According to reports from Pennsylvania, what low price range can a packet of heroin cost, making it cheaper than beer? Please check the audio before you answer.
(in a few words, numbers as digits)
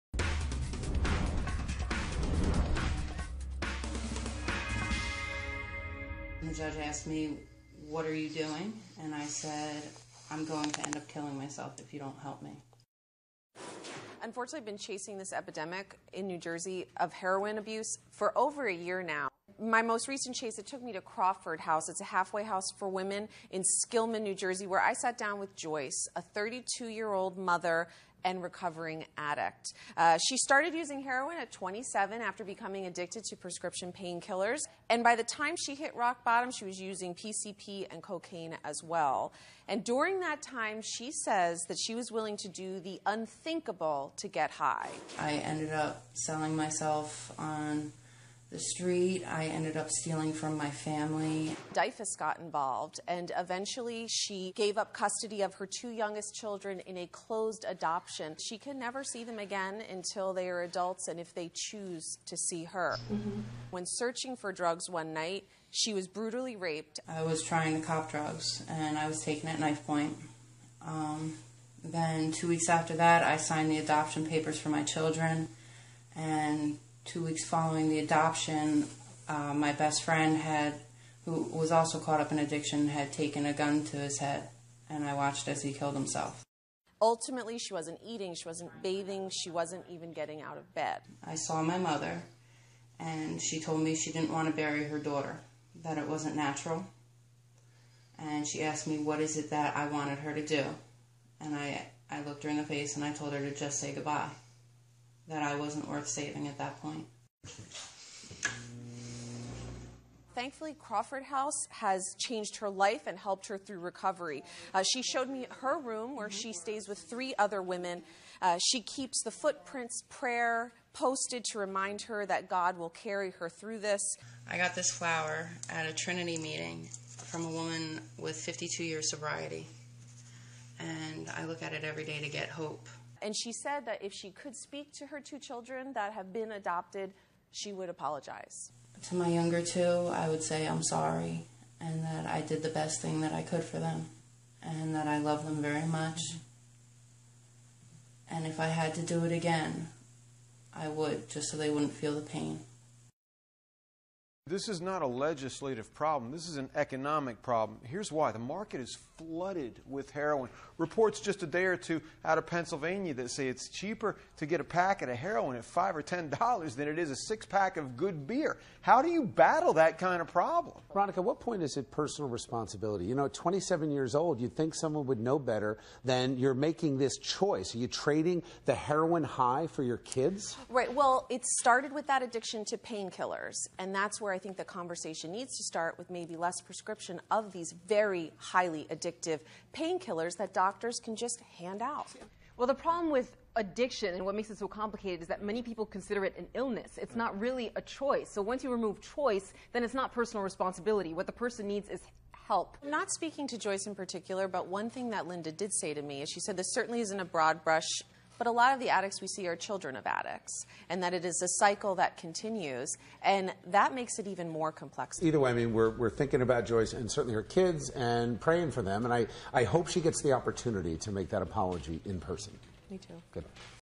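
5 or 10 dollars.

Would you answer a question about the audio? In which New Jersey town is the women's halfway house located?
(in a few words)
Skillman.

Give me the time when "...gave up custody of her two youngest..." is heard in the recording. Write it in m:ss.
0:54.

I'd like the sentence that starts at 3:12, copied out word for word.
Well, the problem with addiction and what makes it so complicated is that many people consider it an illness.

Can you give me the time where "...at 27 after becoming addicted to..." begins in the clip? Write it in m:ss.
0:31.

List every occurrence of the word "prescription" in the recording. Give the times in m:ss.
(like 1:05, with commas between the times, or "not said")
0:33, 3:06.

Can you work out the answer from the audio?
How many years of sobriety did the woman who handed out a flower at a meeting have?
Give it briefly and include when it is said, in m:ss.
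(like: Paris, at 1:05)
52 years, at 2:08.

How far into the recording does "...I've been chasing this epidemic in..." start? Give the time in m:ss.
0:14.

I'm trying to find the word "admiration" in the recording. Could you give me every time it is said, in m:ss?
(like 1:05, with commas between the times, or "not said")
not said.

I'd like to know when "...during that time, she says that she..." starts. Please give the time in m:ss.
0:39.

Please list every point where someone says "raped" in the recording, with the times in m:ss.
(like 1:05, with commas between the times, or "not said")
1:06.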